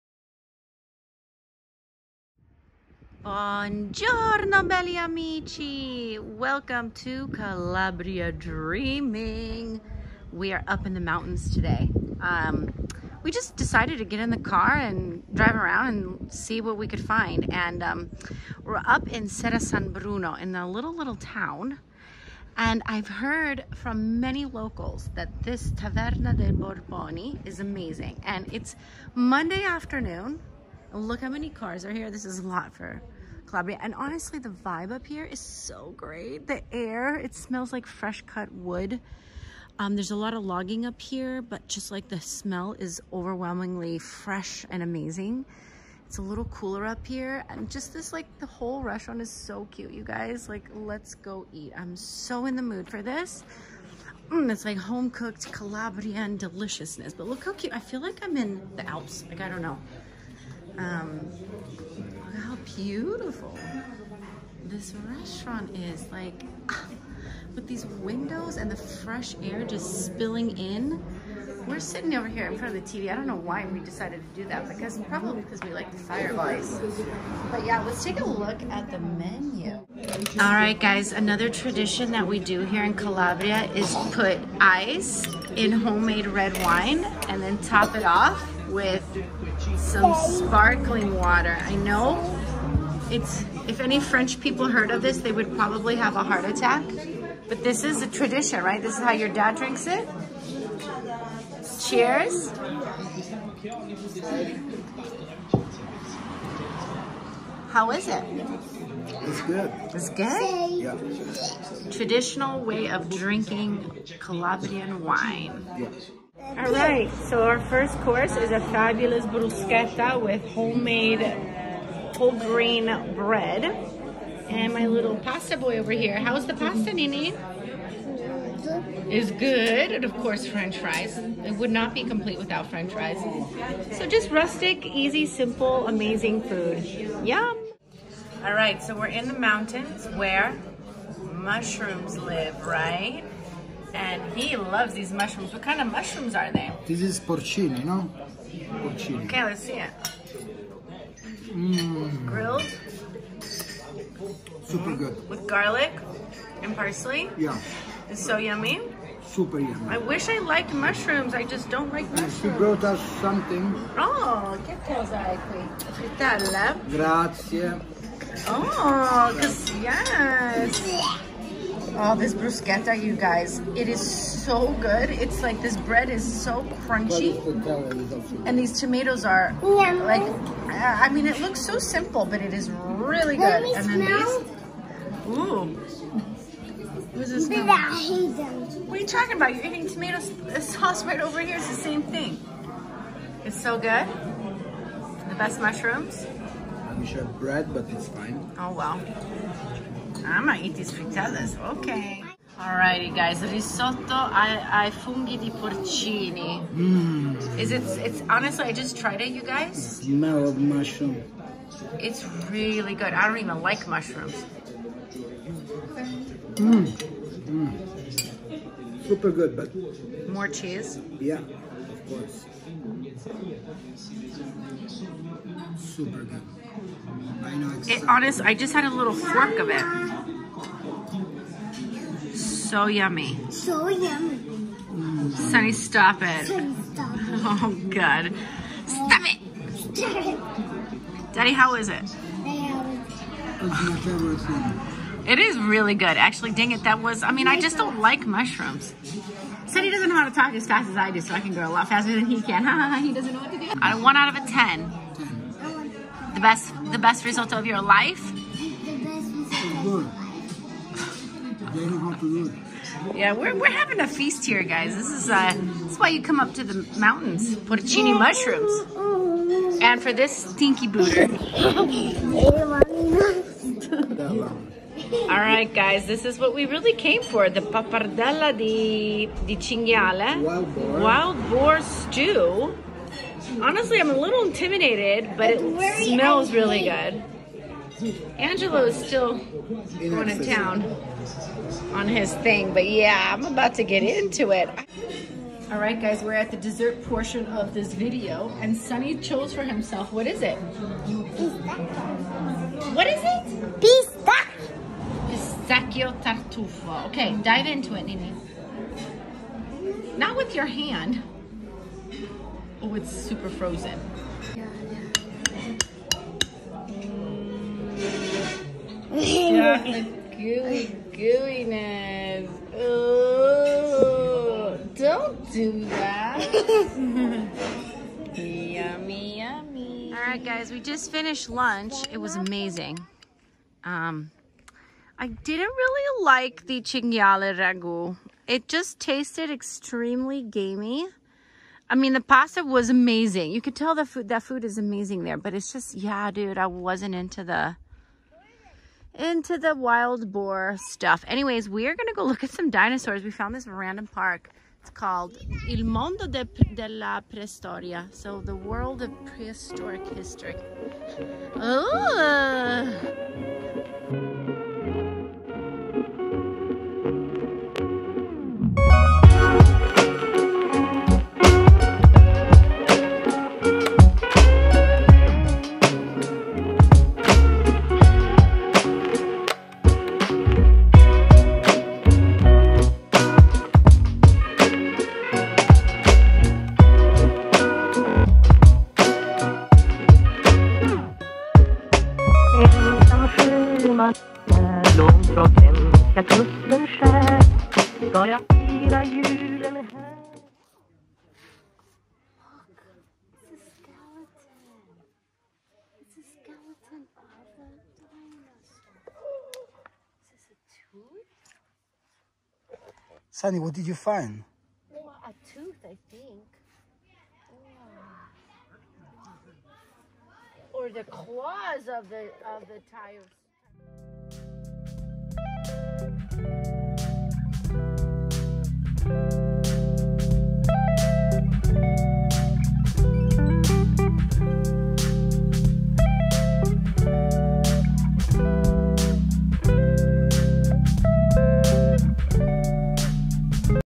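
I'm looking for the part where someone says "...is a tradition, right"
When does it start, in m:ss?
1:37.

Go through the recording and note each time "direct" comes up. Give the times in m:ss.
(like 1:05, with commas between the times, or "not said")
not said.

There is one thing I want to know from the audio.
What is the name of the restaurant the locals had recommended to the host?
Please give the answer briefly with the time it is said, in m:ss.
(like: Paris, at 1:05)
Taverna del Borboni, at 0:25.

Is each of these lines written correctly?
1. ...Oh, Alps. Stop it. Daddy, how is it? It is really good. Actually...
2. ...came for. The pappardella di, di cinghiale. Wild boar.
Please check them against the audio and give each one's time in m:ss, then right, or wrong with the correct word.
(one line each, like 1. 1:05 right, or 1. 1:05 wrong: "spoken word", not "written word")
1. 3:57 wrong: "God", not "Alps"
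2. 4:36 right.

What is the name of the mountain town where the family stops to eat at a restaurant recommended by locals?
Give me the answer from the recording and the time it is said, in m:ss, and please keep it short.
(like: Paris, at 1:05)
Serra San Bruno, at 0:19.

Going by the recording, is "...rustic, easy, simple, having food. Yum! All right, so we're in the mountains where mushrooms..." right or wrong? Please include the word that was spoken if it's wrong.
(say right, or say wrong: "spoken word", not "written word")
wrong: "amazing", not "having".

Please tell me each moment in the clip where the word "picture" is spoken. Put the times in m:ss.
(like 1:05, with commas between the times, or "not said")
not said.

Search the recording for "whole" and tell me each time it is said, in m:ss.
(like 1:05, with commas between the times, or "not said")
0:48, 2:02.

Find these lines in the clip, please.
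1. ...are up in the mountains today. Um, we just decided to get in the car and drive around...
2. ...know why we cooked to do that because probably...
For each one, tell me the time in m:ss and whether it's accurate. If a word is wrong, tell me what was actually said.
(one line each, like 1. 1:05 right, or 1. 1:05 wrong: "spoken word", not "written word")
1. 0:10 right
2. 1:13 wrong: "decided", not "cooked".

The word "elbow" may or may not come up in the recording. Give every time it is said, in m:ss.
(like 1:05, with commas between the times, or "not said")
not said.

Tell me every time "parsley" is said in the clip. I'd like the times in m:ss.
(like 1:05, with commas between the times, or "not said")
2:36.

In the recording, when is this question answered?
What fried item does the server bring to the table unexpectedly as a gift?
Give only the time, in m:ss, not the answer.
2:45.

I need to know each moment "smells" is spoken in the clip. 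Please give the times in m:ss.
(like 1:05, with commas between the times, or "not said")
0:37, 0:42, 3:04, 3:30, 4:46.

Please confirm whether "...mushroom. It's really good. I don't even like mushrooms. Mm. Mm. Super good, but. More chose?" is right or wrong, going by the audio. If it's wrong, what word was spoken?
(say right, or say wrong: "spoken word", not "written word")
wrong: "cheese", not "chose".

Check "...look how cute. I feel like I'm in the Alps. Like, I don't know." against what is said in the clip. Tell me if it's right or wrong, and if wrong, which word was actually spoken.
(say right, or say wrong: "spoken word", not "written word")
right.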